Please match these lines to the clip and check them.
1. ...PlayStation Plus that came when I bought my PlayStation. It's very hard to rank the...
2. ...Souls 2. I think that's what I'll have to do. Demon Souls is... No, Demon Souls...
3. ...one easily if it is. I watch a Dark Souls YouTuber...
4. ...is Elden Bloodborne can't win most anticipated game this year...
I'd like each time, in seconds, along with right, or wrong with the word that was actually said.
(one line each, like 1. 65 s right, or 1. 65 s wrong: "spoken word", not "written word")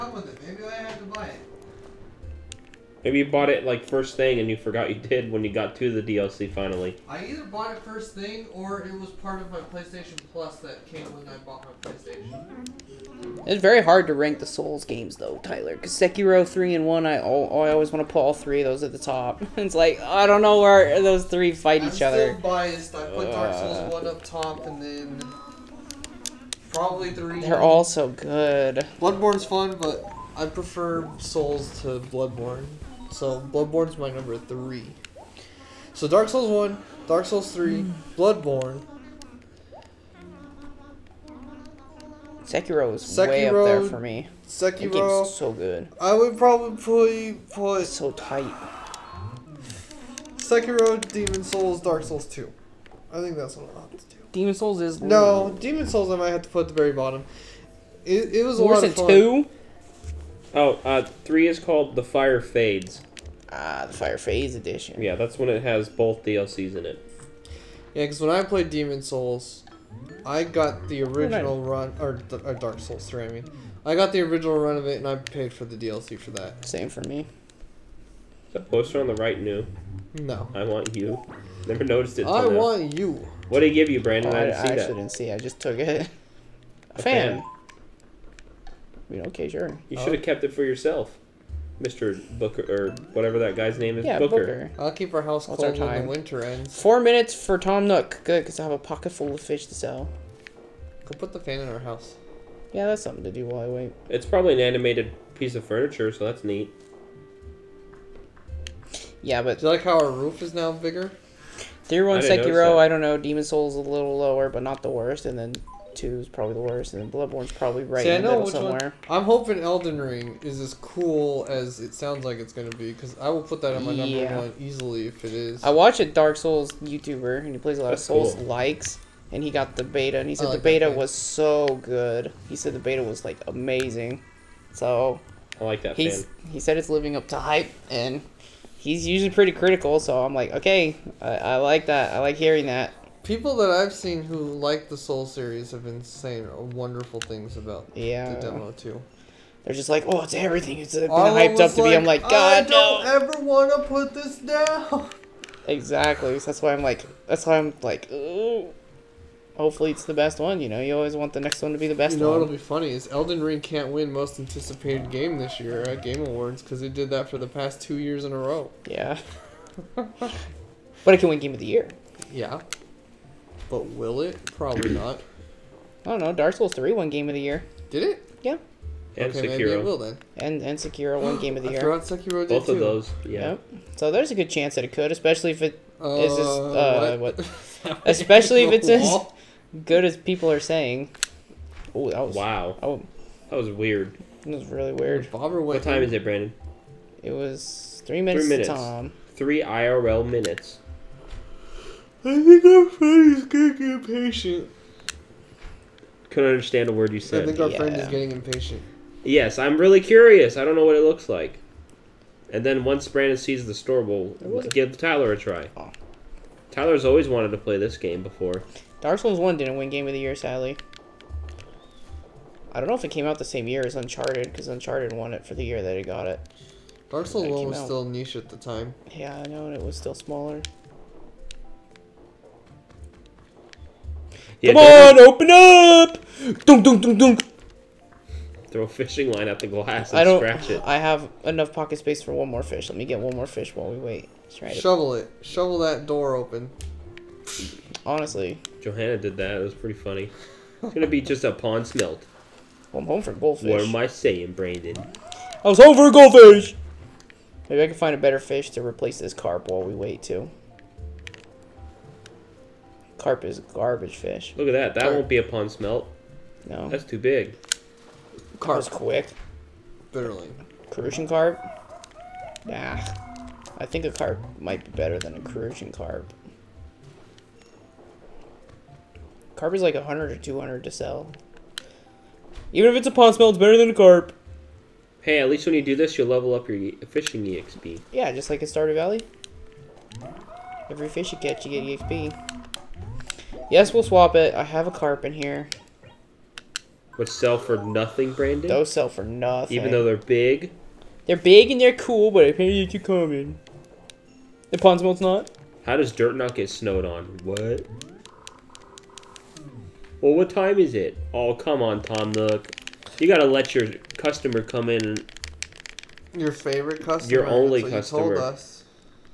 1. 9 s right
2. 52 s right
3. 124 s right
4. 162 s wrong: "Ring", not "Bloodborne".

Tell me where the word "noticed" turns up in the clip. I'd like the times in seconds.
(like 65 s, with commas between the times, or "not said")
81 s.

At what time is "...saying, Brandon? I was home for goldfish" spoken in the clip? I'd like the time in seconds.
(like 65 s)
254 s.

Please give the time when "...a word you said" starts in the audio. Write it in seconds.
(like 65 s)
206 s.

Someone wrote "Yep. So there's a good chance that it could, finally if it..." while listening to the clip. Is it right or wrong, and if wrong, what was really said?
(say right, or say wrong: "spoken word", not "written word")
wrong: "especially", not "finally".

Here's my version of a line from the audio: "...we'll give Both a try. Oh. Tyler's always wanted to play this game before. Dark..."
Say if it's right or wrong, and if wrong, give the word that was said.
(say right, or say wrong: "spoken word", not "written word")
wrong: "Tyler", not "Both".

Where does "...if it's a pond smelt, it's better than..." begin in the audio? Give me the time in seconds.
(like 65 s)
282 s.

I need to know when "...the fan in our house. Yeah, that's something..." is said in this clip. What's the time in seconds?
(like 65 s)
101 s.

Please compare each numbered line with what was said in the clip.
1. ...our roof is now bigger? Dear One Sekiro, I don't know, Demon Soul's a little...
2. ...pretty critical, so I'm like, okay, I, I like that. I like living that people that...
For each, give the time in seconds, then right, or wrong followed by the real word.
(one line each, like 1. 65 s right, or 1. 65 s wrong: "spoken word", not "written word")
1. 109 s right
2. 139 s wrong: "hearing", not "living".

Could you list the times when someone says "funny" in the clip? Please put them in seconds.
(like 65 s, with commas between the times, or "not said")
162 s, 249 s.